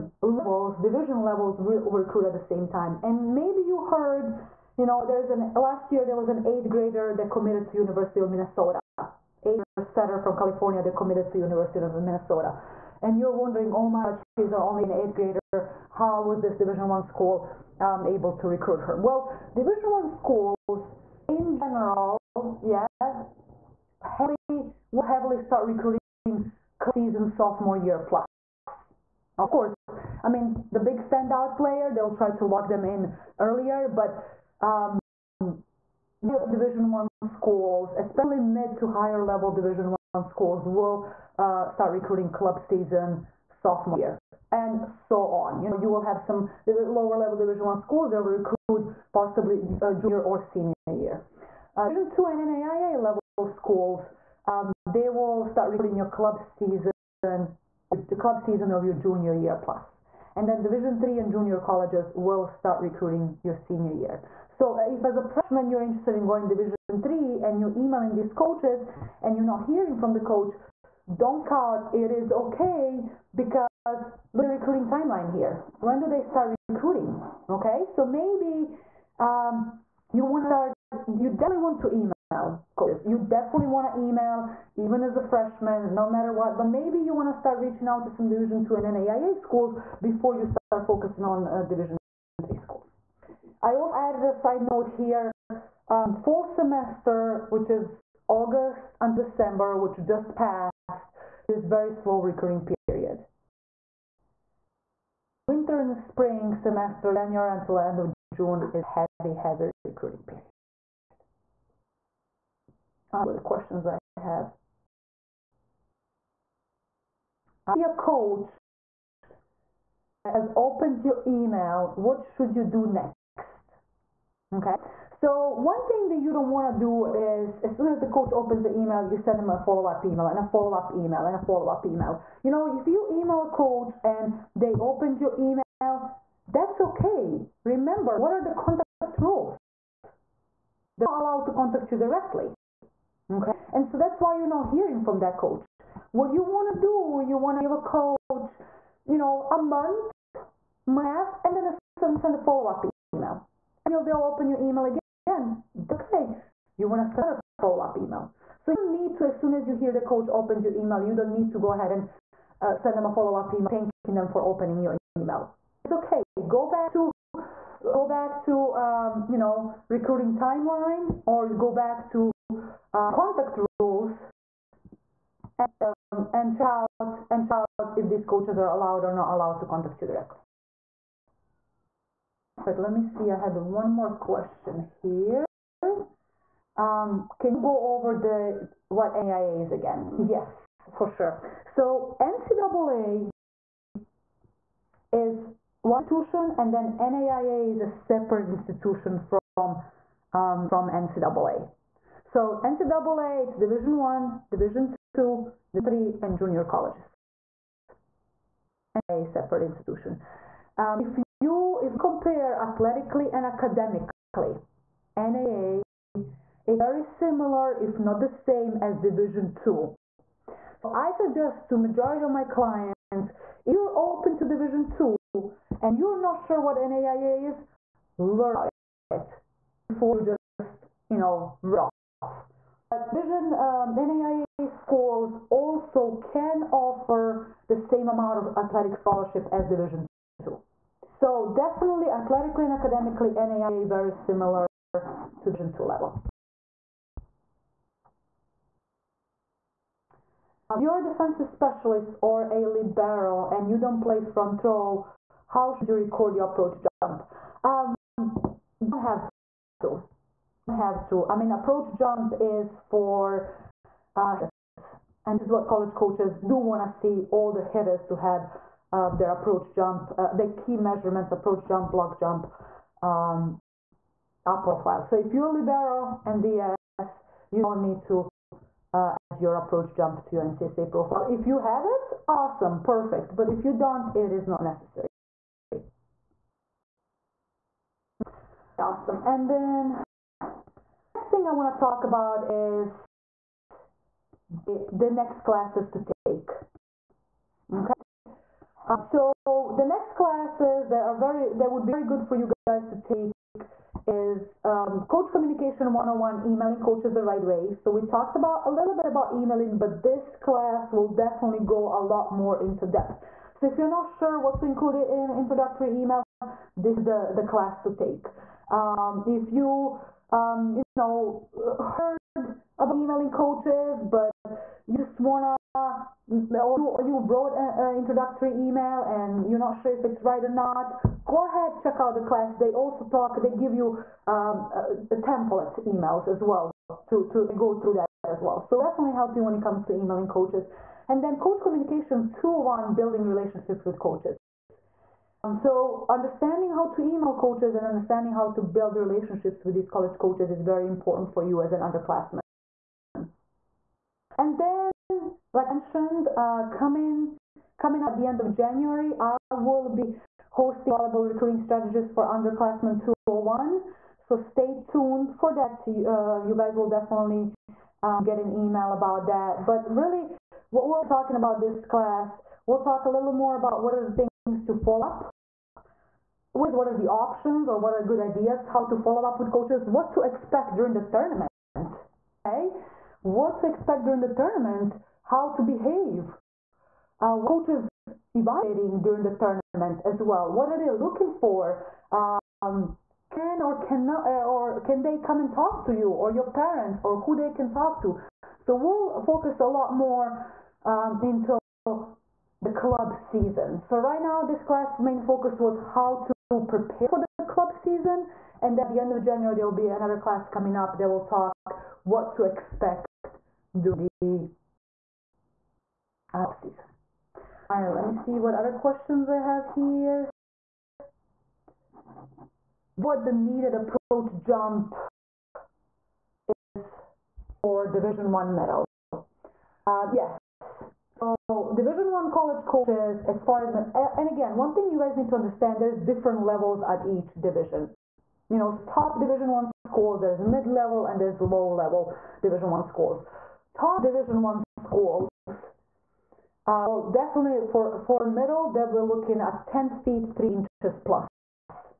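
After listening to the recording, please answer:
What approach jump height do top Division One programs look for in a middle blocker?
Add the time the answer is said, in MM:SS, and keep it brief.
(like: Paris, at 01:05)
10 feet 3 inches, at 07:29.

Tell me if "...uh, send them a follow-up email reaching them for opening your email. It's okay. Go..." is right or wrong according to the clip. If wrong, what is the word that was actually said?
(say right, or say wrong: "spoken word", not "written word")
wrong: "thanking", not "reaching".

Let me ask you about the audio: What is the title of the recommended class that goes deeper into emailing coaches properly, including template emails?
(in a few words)
Coach Communication 101.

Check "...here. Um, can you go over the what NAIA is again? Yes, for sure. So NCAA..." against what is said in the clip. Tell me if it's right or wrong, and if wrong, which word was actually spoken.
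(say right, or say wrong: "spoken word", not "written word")
right.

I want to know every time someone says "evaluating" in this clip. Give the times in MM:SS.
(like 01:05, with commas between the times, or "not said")
06:28.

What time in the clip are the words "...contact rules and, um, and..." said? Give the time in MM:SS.
02:53.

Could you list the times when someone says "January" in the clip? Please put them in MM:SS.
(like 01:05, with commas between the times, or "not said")
01:47, 05:58, 06:49.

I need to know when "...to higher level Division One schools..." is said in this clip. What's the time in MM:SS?
00:38.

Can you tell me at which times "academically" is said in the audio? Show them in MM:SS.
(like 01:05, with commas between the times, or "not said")
03:33, 04:02.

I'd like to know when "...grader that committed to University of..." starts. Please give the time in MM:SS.
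00:06.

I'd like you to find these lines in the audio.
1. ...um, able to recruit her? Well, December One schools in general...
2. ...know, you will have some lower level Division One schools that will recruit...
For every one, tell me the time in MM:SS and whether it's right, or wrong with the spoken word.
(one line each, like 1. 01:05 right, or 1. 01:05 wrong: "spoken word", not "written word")
1. 00:17 wrong: "Division", not "December"
2. 00:45 right.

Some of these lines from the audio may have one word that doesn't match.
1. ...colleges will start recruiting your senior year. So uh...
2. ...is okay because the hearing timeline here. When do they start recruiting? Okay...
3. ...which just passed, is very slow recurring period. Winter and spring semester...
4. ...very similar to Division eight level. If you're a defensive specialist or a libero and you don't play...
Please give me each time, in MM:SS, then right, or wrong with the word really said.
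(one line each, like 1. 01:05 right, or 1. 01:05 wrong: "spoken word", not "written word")
1. 01:01 right
2. 01:12 wrong: "recruiting", not "hearing"
3. 01:39 right
4. 04:03 wrong: "two", not "eight".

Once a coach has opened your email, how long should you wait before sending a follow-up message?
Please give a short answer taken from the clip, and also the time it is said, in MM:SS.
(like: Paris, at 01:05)
A month, at 02:29.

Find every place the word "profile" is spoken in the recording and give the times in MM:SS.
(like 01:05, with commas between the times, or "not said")
04:34, 04:40.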